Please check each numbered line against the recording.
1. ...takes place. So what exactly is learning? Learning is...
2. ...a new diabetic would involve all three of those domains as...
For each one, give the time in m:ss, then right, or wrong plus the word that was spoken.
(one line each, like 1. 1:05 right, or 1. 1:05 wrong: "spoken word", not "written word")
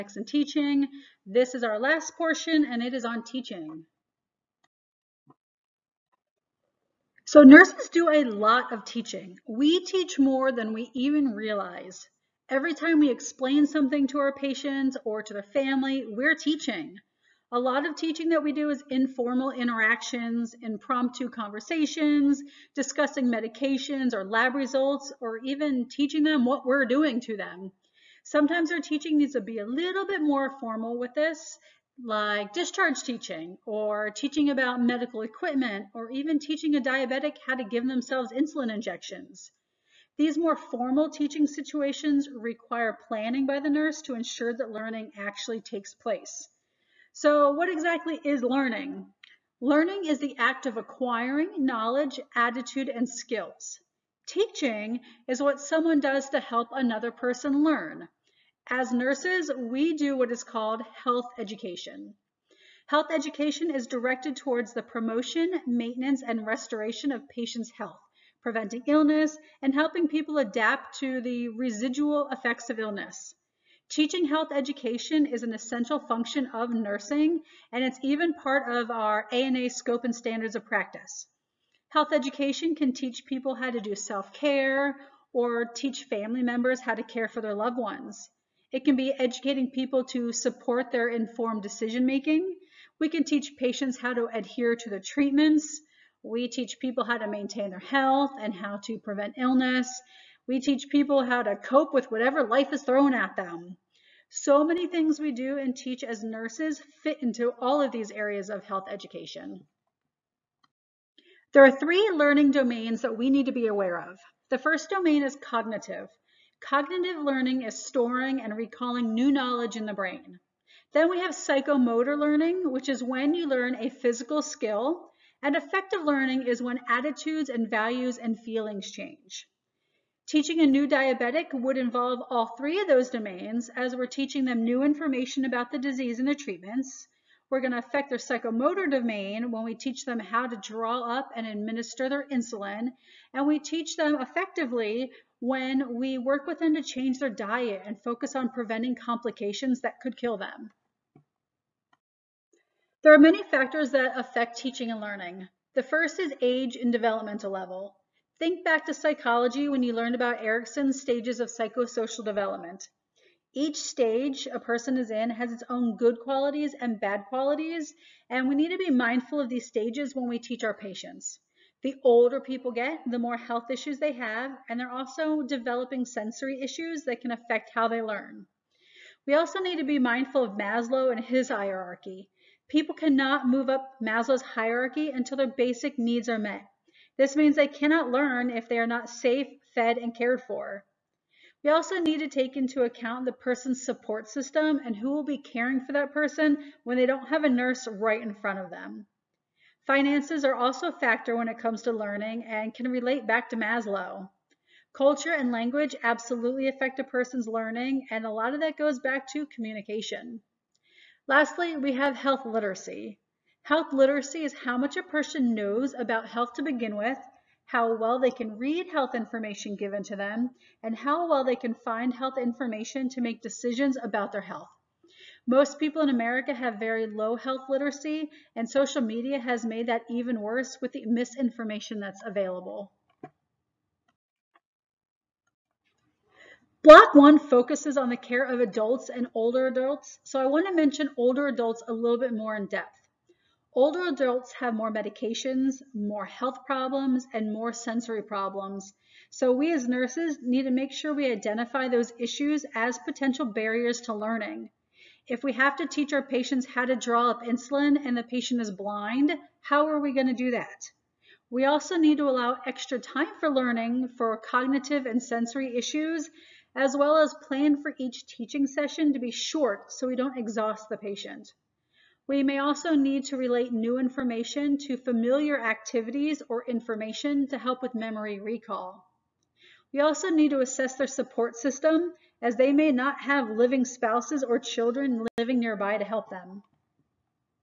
1. 0:45 right
2. 2:10 right.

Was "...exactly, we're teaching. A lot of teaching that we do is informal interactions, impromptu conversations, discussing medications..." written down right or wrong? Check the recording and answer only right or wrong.
wrong.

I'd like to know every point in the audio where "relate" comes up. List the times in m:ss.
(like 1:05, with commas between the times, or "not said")
3:22, 4:33.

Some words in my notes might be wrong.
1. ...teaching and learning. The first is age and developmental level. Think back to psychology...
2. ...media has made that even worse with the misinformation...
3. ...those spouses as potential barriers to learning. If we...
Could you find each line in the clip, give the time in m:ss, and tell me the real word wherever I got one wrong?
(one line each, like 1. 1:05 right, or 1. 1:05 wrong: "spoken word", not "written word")
1. 2:34 right
2. 3:49 right
3. 4:11 wrong: "issues", not "spouses".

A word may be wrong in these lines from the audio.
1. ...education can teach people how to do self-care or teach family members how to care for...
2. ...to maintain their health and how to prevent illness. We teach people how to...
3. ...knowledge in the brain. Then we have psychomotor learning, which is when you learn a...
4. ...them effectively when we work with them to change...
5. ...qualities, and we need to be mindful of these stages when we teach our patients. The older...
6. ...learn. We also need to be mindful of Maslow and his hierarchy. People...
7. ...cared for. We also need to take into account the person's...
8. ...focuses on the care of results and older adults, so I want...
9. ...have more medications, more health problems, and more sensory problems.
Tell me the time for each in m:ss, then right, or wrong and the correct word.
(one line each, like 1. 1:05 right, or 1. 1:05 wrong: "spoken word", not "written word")
1. 1:22 right
2. 1:37 right
3. 1:59 right
4. 2:23 right
5. 2:47 right
6. 2:58 right
7. 3:10 right
8. 3:57 wrong: "adults", not "results"
9. 4:04 right.